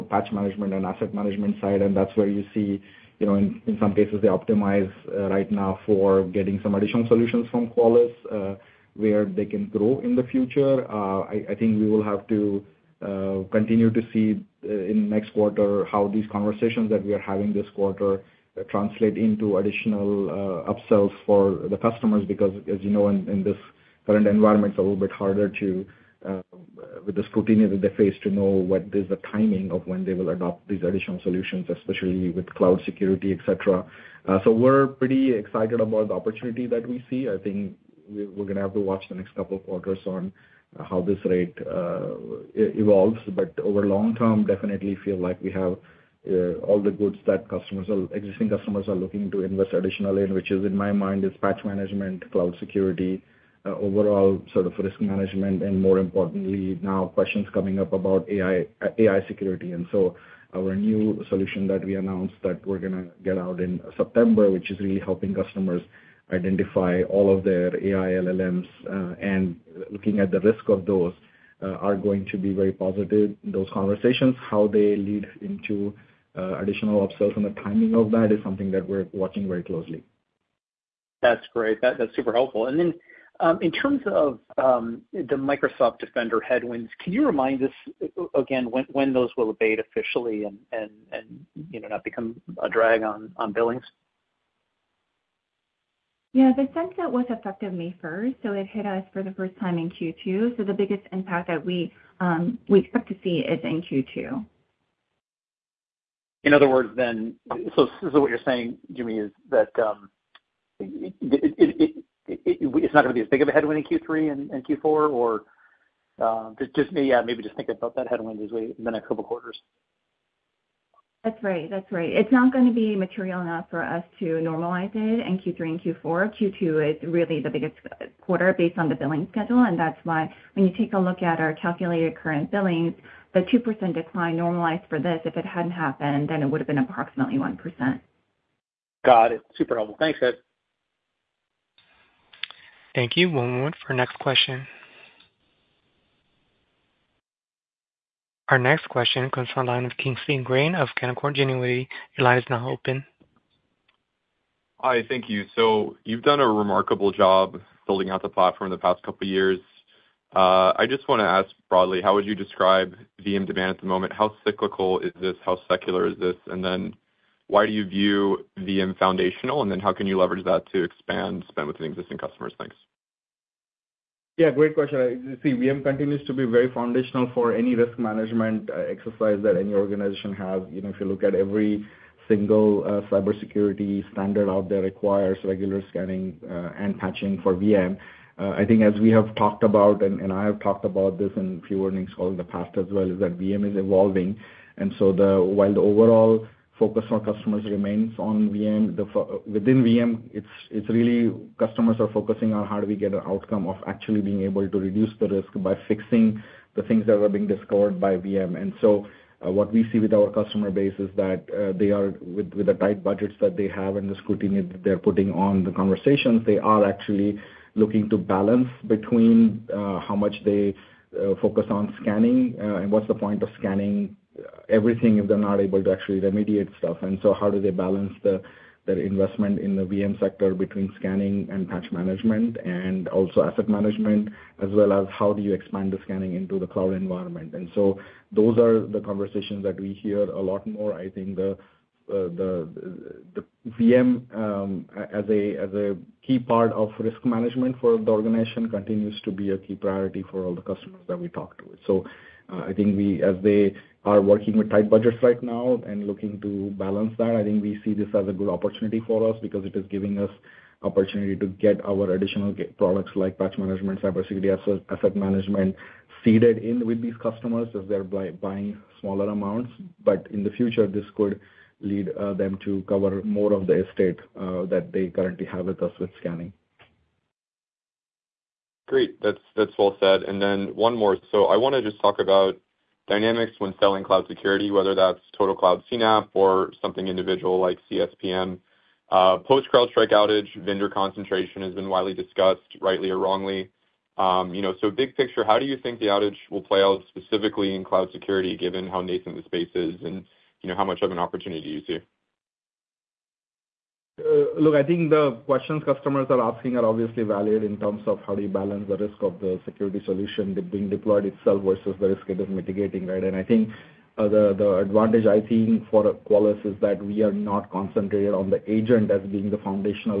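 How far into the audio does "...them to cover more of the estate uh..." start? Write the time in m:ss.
4:32.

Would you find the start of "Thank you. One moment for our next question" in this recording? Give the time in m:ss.
2:22.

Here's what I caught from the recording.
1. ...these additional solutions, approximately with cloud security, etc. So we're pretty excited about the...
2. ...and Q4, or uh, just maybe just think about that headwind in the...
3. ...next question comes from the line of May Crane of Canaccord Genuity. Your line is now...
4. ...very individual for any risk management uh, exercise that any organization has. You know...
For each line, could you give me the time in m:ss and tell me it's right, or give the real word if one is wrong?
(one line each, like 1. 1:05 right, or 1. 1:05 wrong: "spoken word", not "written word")
1. 0:30 wrong: "especially", not "approximately"
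2. 1:54 right
3. 2:28 wrong: "Kingsley", not "May"
4. 2:56 wrong: "foundational", not "individual".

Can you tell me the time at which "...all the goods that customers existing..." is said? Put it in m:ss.
0:46.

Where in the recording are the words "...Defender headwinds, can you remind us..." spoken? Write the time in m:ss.
1:25.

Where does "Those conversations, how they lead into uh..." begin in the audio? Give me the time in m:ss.
1:13.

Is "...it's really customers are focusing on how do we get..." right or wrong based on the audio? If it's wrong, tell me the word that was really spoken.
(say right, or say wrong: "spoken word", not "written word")
right.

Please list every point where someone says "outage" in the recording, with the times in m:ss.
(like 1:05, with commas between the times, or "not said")
4:50, 4:56.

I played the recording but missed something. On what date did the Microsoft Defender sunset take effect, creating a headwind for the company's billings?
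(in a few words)
May 1st.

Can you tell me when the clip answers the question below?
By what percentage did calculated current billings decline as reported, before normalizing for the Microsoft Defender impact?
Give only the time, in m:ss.
2:13.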